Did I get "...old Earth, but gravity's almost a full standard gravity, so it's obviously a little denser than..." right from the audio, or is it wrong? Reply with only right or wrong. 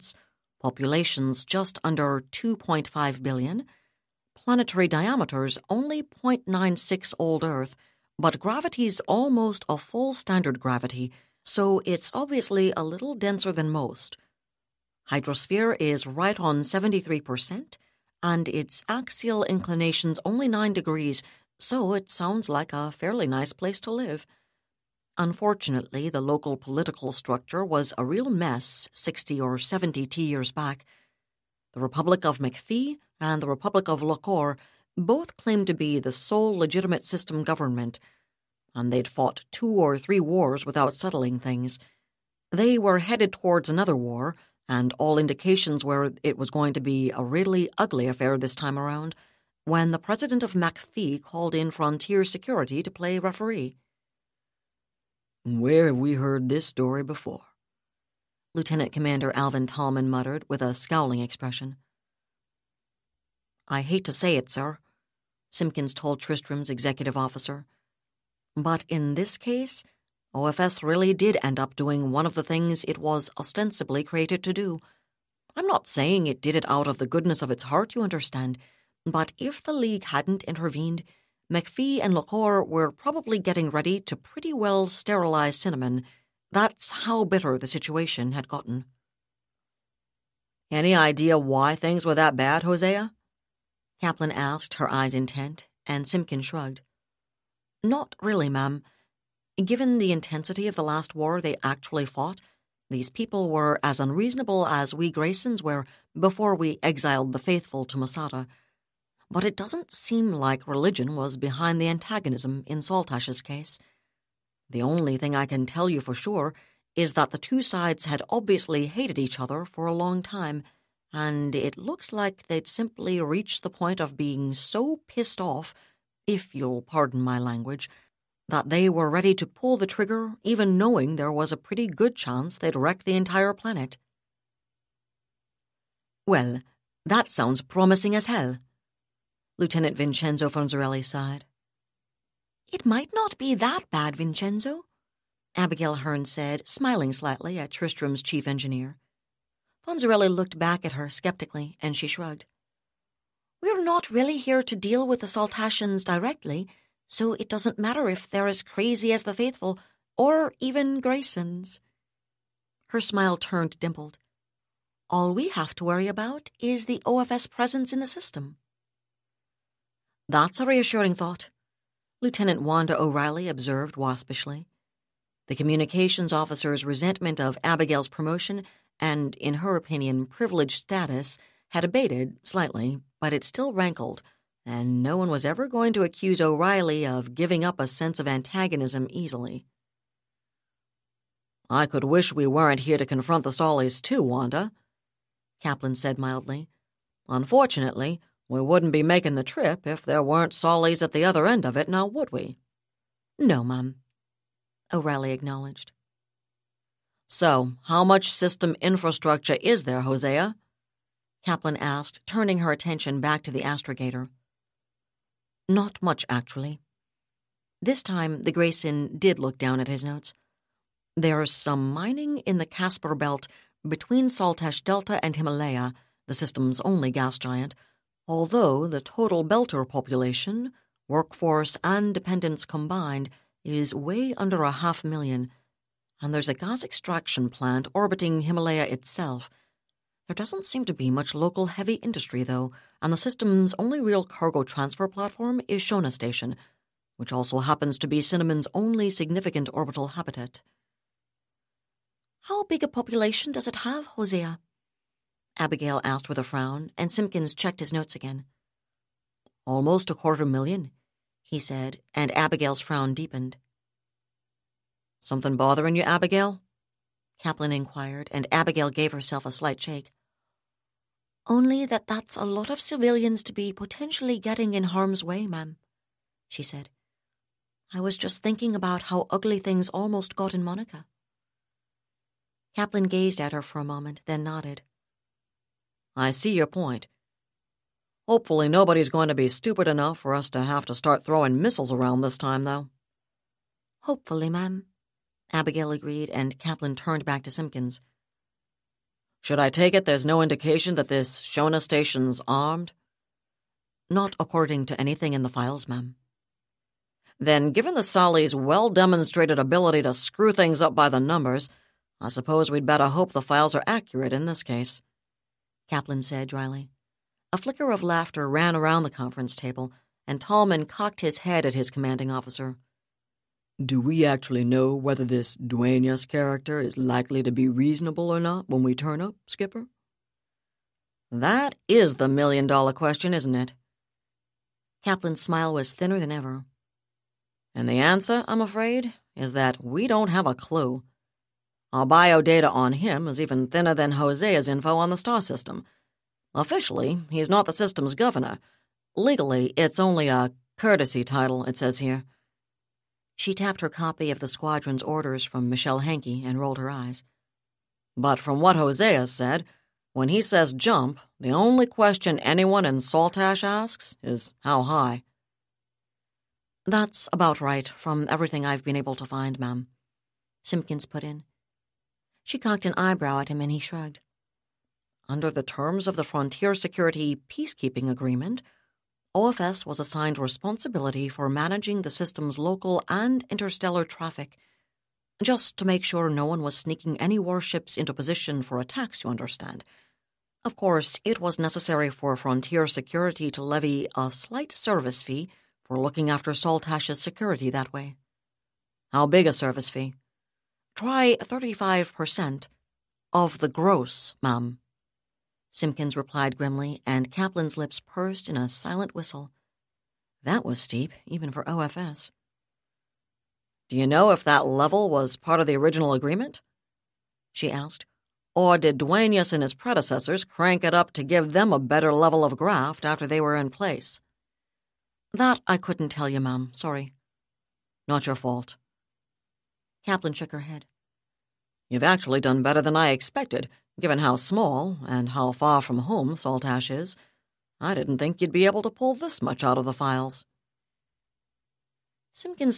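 right.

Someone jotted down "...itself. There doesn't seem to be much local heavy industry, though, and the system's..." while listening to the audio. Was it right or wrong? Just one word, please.
right.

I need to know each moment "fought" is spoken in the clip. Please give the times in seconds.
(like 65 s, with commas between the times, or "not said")
39 s, 102 s.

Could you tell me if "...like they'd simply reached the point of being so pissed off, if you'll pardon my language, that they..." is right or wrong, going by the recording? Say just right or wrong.
right.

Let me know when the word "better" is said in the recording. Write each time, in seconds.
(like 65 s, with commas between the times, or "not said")
312 s, 421 s, 432 s.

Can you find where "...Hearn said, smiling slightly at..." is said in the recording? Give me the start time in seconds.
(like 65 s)
145 s.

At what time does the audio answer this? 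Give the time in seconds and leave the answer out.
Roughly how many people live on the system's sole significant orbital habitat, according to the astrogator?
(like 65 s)
259 s.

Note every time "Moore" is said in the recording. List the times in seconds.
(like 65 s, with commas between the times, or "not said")
not said.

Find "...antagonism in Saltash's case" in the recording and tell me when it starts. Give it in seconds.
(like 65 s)
111 s.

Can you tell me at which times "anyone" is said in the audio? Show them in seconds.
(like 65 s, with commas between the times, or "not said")
362 s.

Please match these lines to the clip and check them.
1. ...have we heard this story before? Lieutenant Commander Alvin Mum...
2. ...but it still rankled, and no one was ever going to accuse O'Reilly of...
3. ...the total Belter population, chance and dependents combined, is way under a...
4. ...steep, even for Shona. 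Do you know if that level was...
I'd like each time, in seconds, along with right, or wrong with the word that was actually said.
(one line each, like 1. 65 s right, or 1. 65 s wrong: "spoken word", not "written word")
1. 55 s wrong: "Tallman", not "Mum"
2. 183 s right
3. 228 s wrong: "workforce", not "chance"
4. 410 s wrong: "OFS", not "Shona".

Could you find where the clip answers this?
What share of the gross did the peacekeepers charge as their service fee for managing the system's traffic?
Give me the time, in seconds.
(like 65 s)
401 s.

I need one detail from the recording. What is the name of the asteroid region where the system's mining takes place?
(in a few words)
Casper Belt.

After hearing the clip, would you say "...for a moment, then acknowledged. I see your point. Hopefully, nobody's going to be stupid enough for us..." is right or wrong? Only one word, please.
wrong.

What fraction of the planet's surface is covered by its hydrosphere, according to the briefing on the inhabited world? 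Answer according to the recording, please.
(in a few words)
73%.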